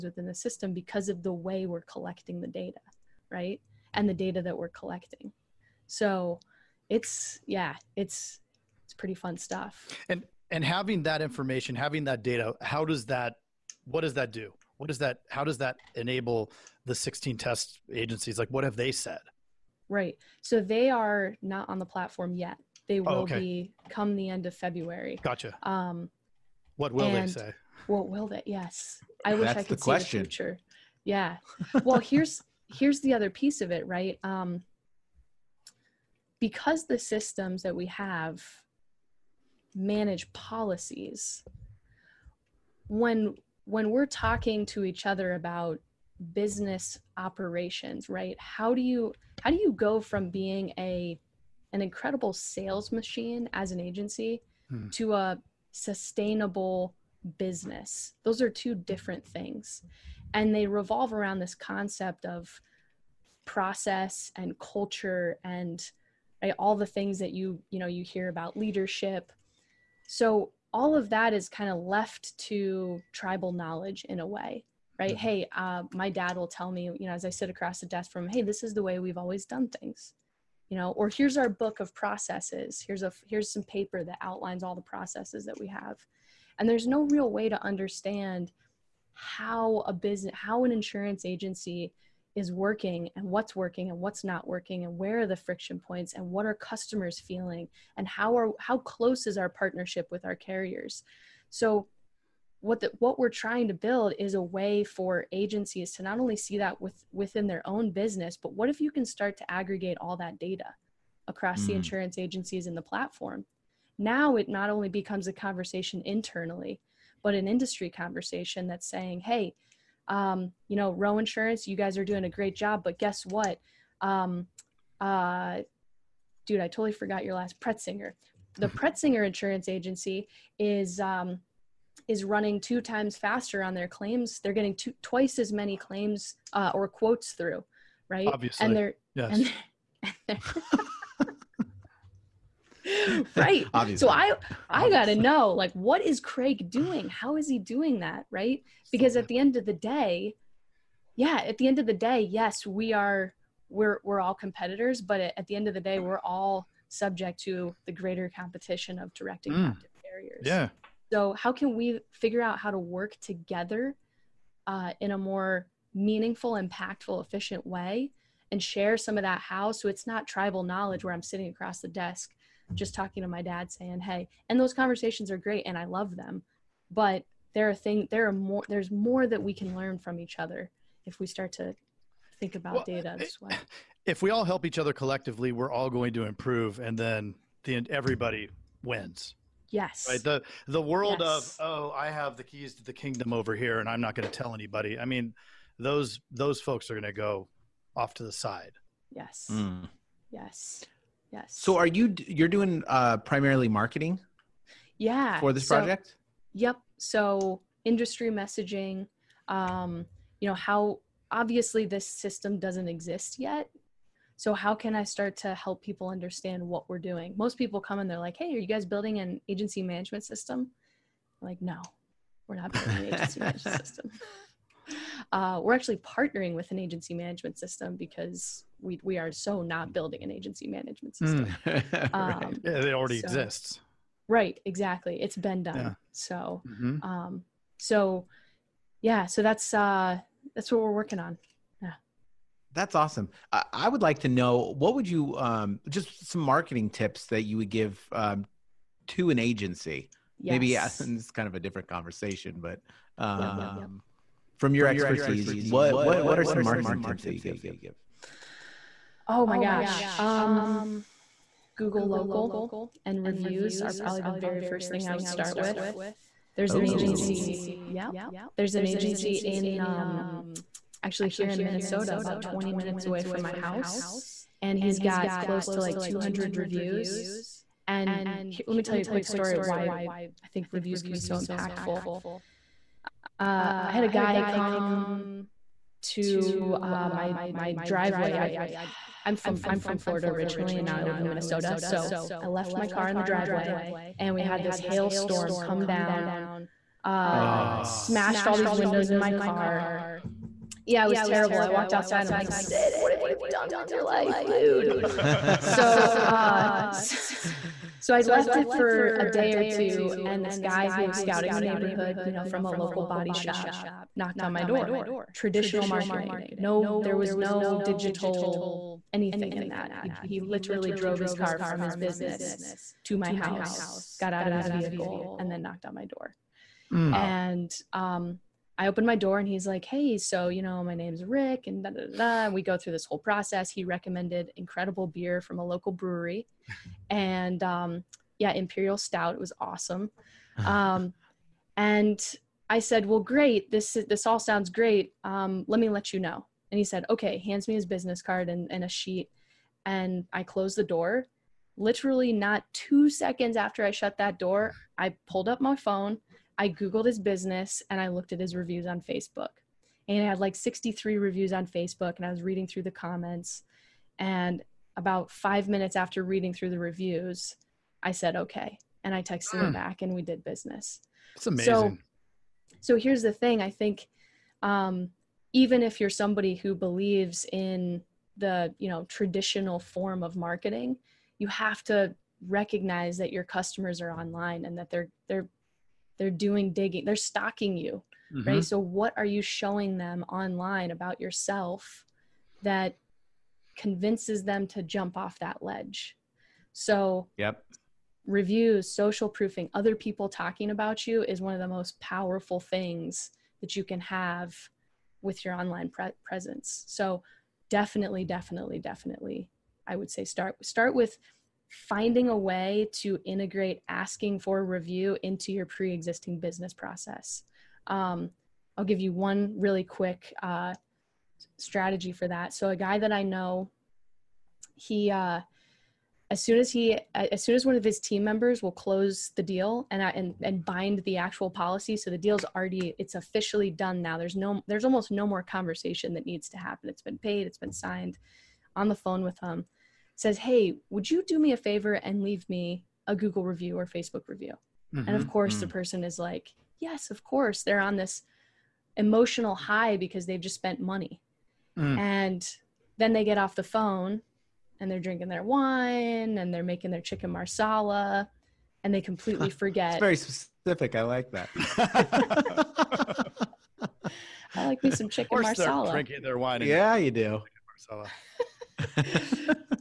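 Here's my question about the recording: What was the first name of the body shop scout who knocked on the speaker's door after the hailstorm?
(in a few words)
Rick.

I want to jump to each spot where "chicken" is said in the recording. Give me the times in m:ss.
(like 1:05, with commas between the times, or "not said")
7:37, 7:45.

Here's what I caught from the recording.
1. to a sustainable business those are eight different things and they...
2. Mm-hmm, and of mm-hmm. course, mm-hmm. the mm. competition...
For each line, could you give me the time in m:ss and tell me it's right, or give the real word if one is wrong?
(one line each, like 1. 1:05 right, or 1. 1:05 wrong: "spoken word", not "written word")
1. 0:54 wrong: "two", not "eight"
2. 7:24 wrong: "person", not "competition".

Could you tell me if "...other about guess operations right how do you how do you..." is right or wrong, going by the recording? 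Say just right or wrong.
wrong.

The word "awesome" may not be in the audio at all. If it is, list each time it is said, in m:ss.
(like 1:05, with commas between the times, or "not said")
4:02, 5:39.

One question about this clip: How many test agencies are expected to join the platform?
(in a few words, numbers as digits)
16.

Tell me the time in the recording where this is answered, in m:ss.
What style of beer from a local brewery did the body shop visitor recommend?
5:38.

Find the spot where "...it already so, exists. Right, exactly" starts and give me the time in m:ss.
3:52.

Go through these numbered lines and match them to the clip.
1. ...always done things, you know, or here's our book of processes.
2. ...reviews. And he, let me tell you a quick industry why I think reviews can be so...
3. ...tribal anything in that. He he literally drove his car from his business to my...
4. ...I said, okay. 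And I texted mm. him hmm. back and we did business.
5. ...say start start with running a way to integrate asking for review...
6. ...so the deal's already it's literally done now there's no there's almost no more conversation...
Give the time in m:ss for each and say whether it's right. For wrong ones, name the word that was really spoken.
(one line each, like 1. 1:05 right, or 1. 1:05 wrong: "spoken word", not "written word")
1. 1:19 right
2. 4:36 wrong: "story", not "industry"
3. 5:17 wrong: "digital", not "tribal"
4. 6:08 right
5. 6:50 wrong: "finding", not "running"
6. 7:11 wrong: "officially", not "literally".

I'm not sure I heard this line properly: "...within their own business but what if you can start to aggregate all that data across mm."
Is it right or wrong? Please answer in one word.
right.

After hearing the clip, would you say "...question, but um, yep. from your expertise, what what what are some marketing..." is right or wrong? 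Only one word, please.
wrong.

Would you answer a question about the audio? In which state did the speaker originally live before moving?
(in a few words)
Florida.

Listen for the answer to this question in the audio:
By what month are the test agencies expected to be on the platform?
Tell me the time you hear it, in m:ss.
0:24.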